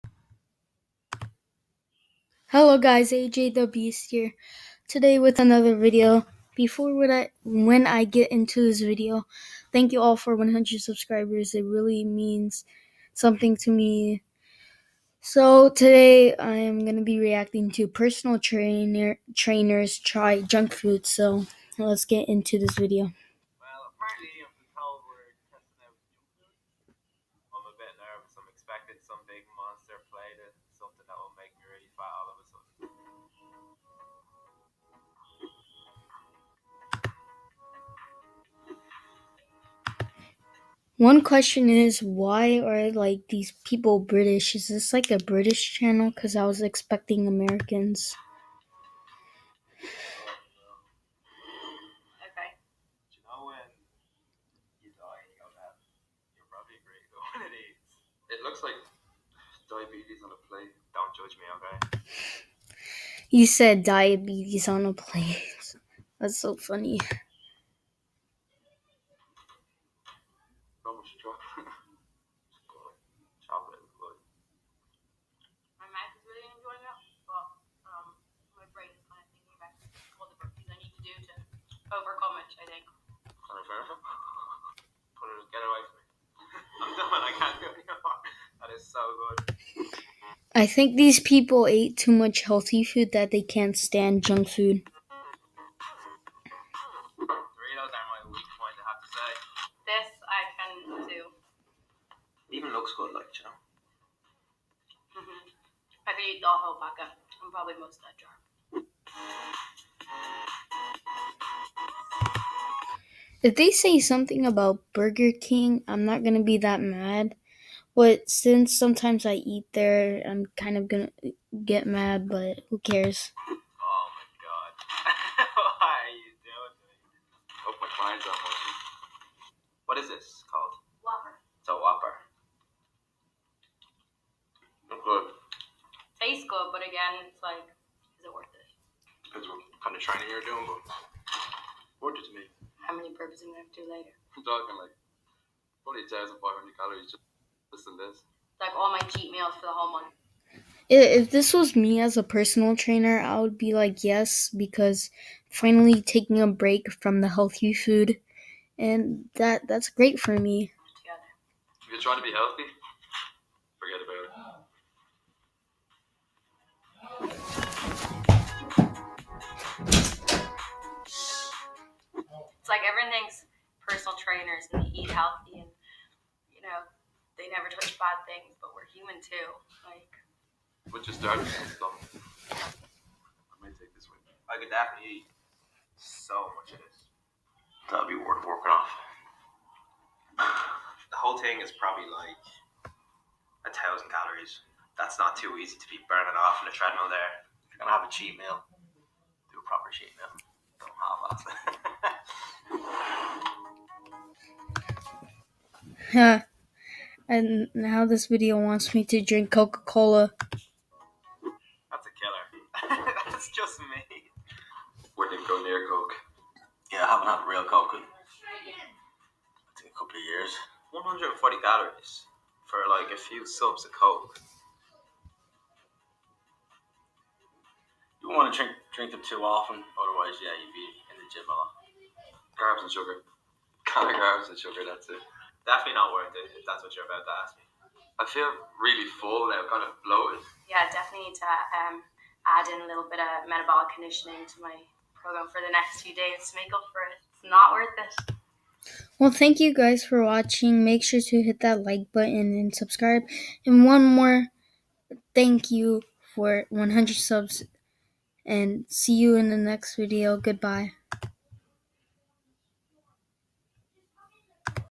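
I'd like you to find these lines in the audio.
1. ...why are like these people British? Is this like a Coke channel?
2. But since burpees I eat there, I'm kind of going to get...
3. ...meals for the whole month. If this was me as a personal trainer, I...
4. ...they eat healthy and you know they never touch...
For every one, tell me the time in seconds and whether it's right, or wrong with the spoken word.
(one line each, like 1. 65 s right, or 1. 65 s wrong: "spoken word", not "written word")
1. 42 s wrong: "British", not "Coke"
2. 117 s wrong: "sometimes", not "burpees"
3. 149 s right
4. 174 s right.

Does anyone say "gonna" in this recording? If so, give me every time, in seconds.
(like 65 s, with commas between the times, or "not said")
16 s, 143 s, 197 s.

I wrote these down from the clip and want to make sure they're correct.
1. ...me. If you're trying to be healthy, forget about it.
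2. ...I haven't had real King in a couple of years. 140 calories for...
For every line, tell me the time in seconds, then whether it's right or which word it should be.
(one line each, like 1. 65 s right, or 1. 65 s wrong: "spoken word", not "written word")
1. 160 s right
2. 217 s wrong: "Coke", not "King".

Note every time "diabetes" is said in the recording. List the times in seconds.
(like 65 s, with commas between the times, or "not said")
59 s, 63 s.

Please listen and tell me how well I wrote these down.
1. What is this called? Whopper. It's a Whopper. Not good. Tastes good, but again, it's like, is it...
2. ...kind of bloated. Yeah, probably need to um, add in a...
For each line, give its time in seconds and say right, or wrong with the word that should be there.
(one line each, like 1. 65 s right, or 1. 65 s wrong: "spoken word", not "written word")
1. 129 s right
2. 239 s wrong: "definitely", not "probably".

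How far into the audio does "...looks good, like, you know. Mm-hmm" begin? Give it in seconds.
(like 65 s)
102 s.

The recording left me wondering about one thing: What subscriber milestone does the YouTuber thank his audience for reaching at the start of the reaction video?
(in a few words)
100 subscribers.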